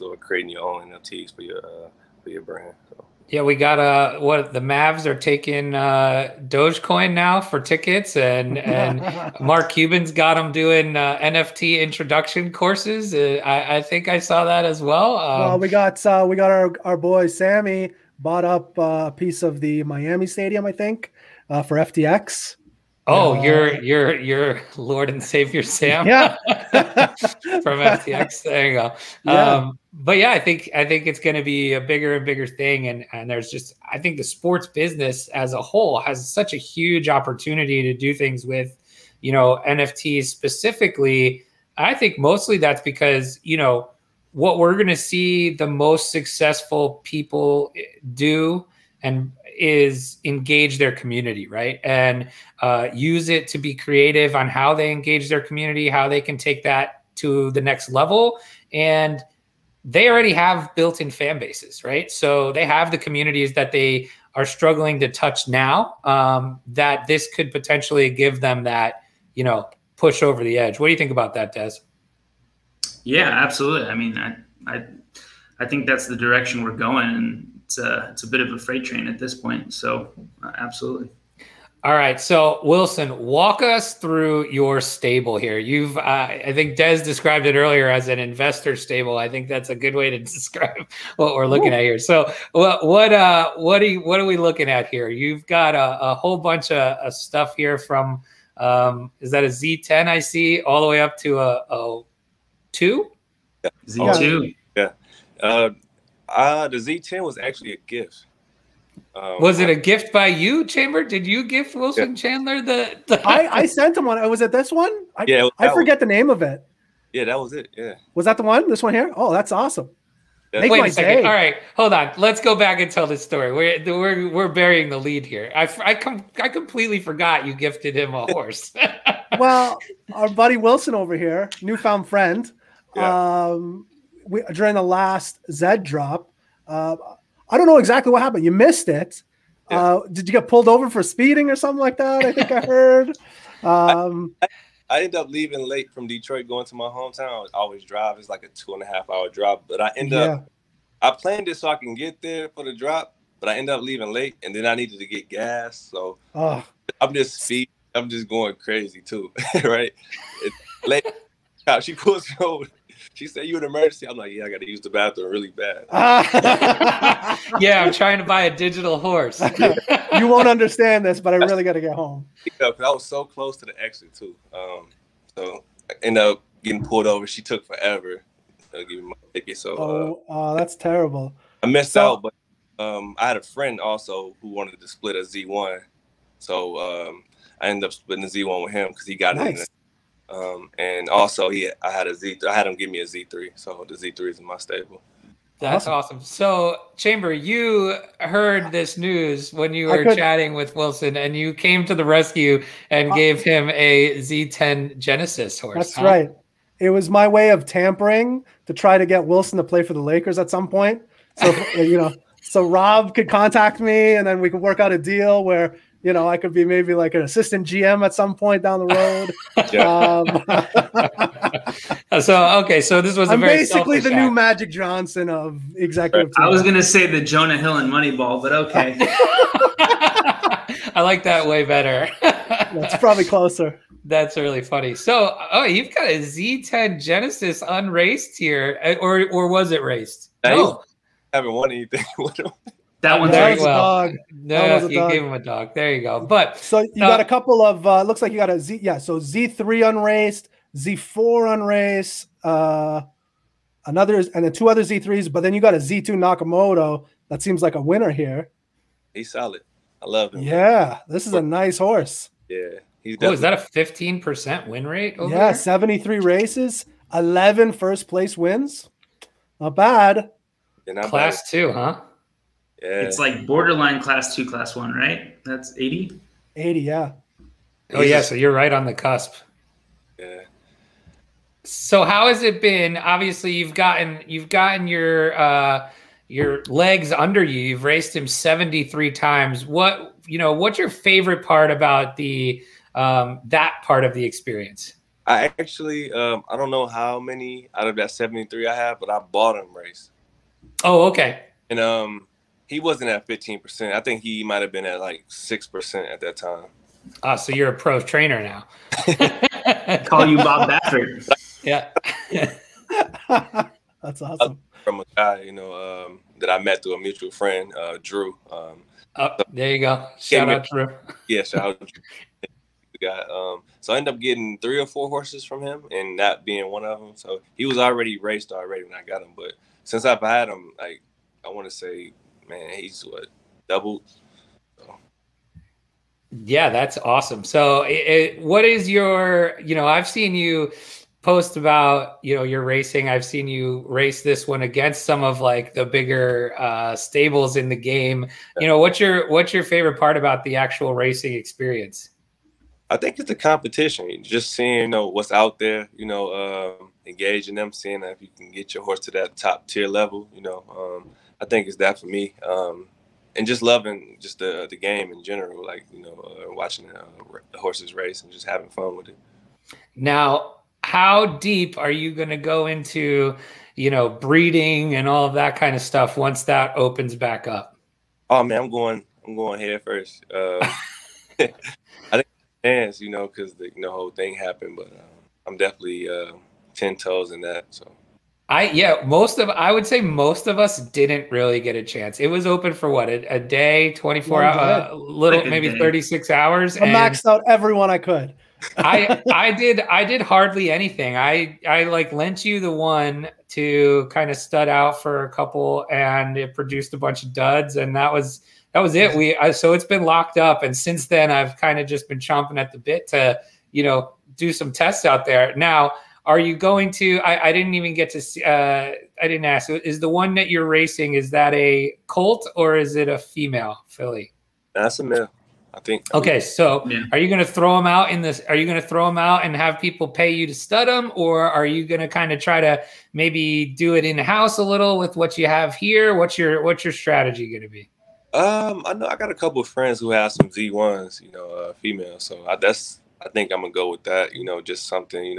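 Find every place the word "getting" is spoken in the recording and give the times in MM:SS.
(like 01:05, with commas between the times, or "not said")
02:56, 05:24.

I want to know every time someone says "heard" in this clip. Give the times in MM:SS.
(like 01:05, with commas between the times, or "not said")
02:22, 03:18.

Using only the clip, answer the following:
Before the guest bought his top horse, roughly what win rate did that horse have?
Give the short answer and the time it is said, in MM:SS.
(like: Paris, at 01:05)
6%, at 05:05.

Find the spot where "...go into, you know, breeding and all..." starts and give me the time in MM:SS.
06:12.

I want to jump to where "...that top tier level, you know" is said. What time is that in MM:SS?
05:59.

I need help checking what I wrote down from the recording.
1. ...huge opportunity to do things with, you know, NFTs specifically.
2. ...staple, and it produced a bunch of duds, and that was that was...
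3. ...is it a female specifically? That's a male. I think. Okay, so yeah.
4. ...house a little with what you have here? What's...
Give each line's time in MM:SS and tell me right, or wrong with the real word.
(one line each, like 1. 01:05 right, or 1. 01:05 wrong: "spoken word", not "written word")
1. 00:36 right
2. 06:45 wrong: "couple", not "staple"
3. 07:02 wrong: "filly", not "specifically"
4. 07:14 right.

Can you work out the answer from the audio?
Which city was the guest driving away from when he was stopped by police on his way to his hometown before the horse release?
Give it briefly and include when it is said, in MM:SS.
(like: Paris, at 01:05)
Detroit, at 02:26.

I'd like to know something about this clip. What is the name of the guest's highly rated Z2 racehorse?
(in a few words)
Nakamoto.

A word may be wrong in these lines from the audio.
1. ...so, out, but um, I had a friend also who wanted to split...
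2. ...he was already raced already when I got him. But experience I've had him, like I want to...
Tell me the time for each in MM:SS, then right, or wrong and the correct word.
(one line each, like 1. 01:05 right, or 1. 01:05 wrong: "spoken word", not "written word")
1. 03:01 right
2. 05:27 wrong: "since", not "experience".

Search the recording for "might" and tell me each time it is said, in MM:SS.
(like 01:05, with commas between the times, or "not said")
05:04.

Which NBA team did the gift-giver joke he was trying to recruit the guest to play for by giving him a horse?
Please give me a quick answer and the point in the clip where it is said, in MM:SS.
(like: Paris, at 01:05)
Lakers, at 03:30.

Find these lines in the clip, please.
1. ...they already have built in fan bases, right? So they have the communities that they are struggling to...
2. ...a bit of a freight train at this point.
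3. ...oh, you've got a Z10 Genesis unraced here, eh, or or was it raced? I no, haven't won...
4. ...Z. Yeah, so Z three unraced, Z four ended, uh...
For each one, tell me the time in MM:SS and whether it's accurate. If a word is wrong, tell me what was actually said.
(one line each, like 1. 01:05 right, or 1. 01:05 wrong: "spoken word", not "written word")
1. 00:59 right
2. 01:18 right
3. 03:55 right
4. 04:08 wrong: "unraced", not "ended".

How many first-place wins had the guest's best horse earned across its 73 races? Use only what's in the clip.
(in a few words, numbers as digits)
11.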